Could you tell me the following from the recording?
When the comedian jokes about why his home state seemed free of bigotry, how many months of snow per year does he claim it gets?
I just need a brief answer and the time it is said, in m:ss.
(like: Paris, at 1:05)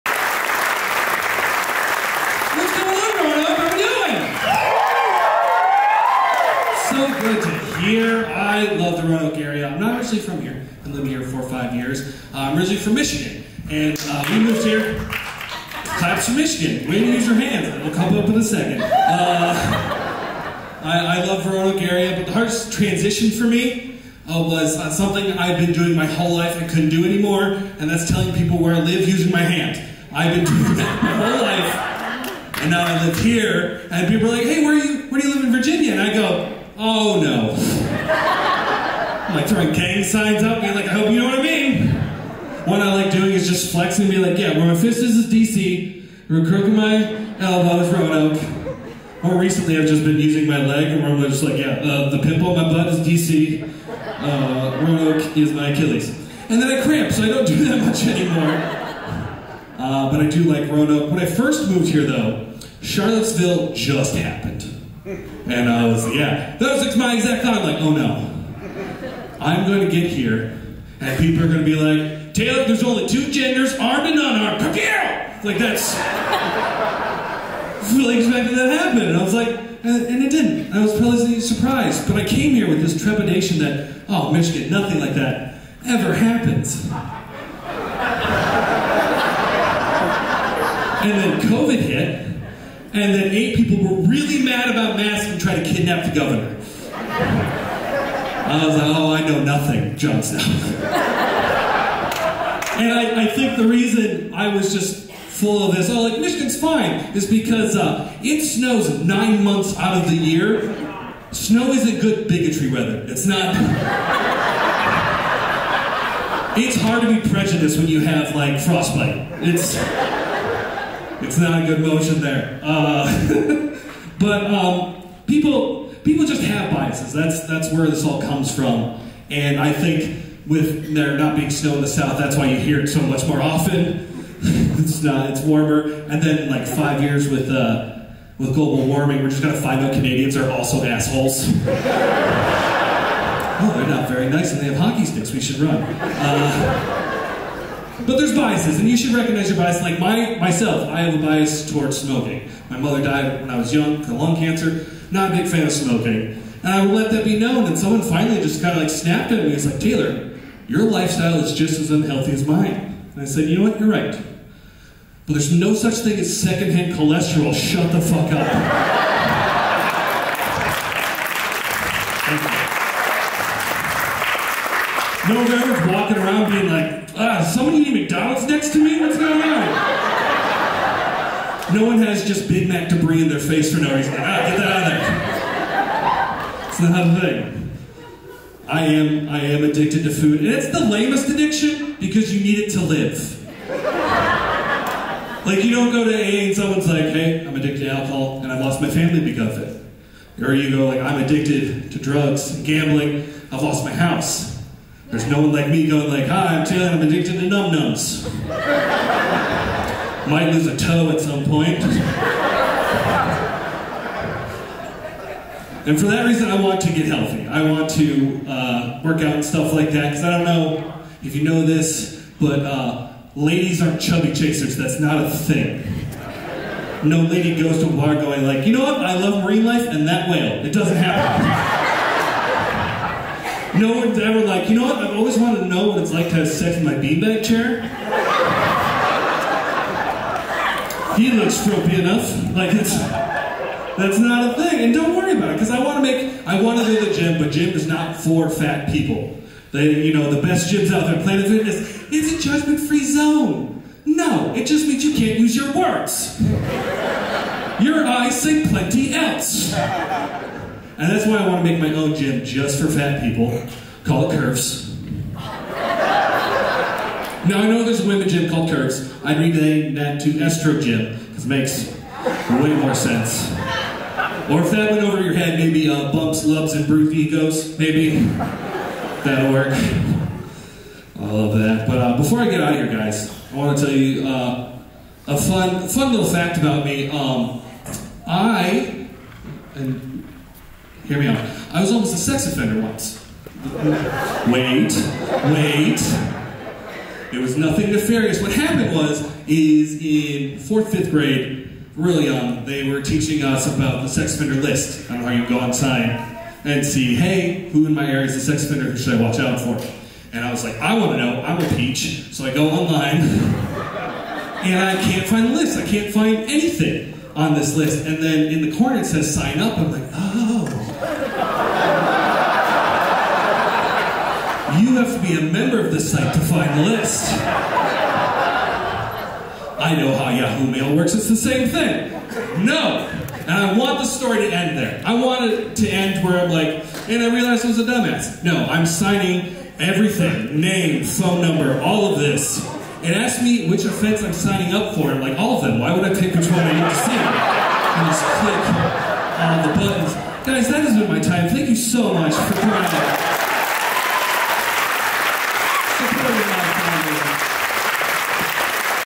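9 months, at 1:49.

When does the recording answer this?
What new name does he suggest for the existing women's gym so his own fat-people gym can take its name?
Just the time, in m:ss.
4:30.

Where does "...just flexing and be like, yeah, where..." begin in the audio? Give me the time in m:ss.
0:43.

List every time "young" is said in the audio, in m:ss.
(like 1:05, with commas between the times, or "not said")
2:33, 5:02.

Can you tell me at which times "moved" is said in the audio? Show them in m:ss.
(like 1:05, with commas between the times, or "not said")
0:14, 1:01.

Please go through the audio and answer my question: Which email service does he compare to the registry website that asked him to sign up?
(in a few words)
Yahoo Mail.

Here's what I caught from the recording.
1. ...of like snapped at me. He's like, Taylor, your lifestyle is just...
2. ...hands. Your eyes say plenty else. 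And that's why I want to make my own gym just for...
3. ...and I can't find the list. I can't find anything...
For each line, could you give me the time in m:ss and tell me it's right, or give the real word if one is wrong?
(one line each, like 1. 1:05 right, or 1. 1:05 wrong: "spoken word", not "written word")
1. 2:38 right
2. 4:15 wrong: "words", not "hands"
3. 5:14 right.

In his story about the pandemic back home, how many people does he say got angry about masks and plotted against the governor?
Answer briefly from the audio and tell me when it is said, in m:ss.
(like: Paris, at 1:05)
8, at 1:33.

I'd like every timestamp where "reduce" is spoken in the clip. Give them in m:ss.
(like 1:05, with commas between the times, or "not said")
not said.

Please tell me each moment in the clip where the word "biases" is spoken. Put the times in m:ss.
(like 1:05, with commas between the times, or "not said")
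2:06, 2:28.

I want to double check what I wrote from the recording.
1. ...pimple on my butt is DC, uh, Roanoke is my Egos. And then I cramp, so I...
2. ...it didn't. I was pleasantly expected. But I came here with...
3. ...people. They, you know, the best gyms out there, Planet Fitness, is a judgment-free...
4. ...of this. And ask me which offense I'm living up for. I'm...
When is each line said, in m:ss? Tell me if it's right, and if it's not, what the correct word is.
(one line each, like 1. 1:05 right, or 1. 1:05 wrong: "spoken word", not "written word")
1. 0:52 wrong: "Achilles", not "Egos"
2. 1:20 wrong: "surprised", not "expected"
3. 4:08 right
4. 5:42 wrong: "signing", not "living".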